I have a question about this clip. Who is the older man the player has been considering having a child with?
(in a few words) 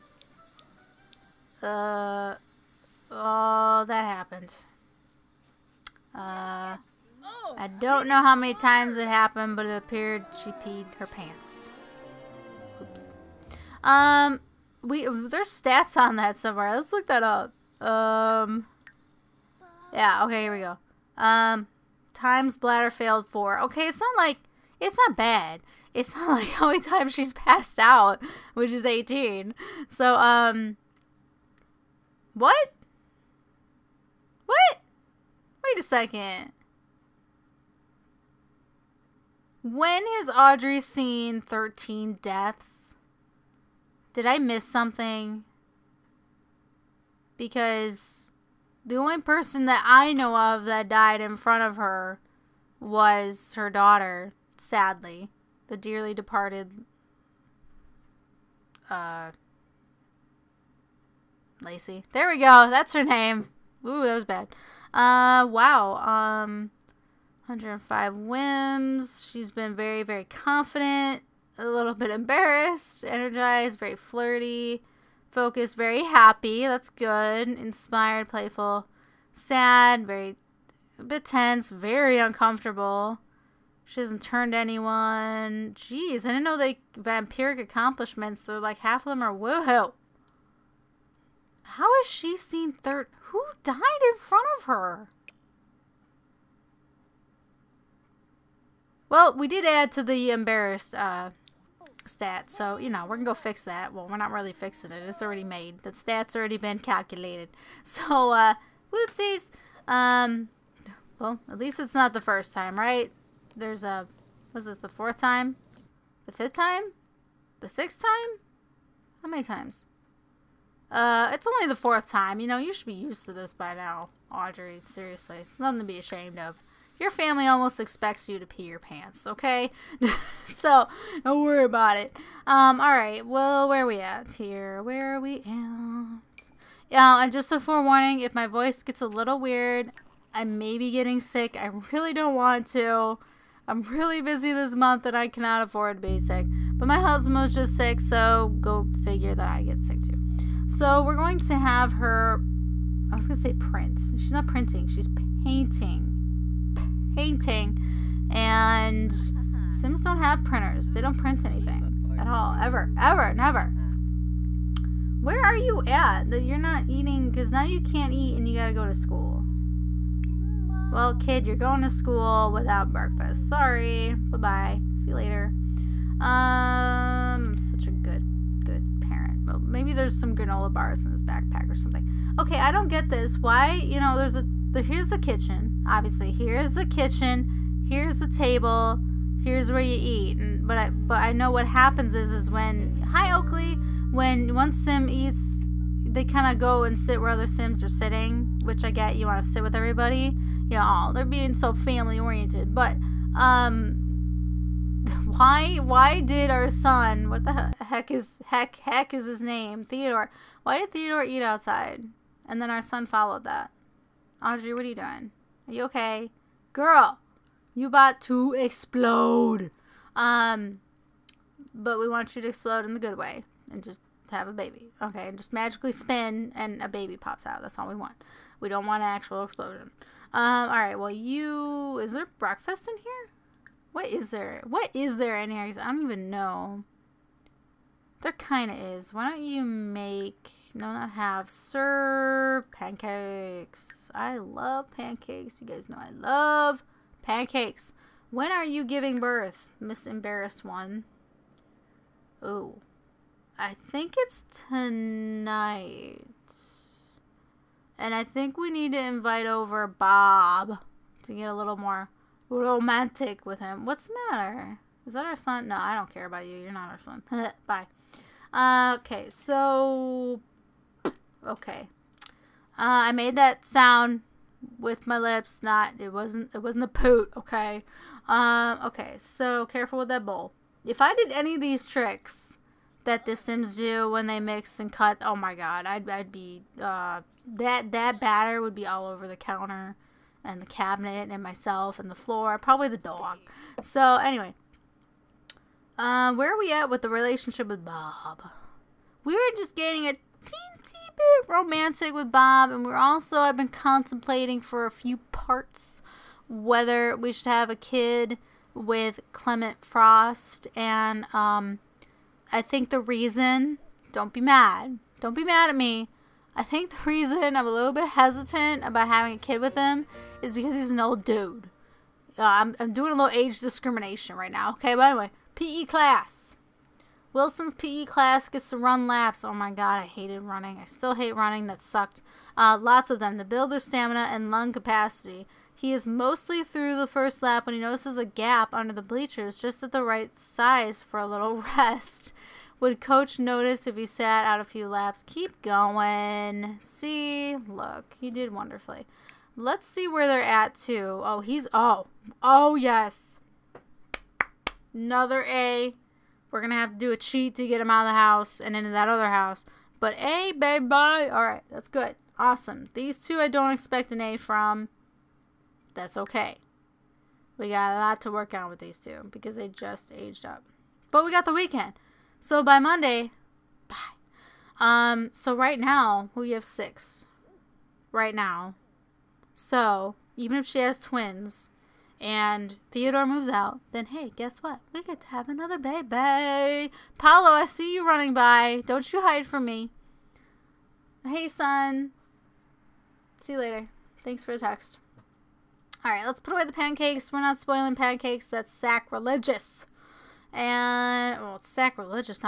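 Clement Frost.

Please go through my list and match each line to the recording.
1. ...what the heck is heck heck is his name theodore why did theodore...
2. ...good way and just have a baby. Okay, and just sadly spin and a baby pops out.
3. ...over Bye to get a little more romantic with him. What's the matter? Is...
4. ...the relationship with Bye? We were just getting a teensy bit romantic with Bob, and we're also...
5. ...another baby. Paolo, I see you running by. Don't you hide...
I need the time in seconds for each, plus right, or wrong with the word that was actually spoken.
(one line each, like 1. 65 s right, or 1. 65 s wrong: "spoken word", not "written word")
1. 207 s right
2. 222 s wrong: "magically", not "sadly"
3. 259 s wrong: "Bob", not "Bye"
4. 297 s wrong: "Bob", not "Bye"
5. 385 s right.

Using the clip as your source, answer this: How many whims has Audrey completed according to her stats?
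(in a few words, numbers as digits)
105.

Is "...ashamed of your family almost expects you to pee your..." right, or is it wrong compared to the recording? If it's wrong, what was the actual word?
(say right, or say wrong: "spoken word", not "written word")
right.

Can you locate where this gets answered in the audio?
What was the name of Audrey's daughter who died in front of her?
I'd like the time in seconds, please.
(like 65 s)
61 s.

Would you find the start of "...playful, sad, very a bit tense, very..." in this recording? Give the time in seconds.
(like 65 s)
78 s.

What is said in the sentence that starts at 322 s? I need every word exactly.
Uh, I'm, I'm doing a little age discrimination right now, okay?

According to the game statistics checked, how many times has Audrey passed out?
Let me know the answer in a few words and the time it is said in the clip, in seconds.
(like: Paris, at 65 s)
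18, at 28 s.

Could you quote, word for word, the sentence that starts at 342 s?
Would coach notice if he sat out a few laps?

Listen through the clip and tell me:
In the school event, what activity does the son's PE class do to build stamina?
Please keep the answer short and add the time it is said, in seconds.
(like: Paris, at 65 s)
Run laps, at 328 s.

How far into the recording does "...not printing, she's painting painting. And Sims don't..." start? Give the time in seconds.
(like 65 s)
154 s.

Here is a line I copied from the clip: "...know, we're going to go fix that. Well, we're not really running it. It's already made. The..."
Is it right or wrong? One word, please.
wrong.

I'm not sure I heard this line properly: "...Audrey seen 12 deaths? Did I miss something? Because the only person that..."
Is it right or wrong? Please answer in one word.
wrong.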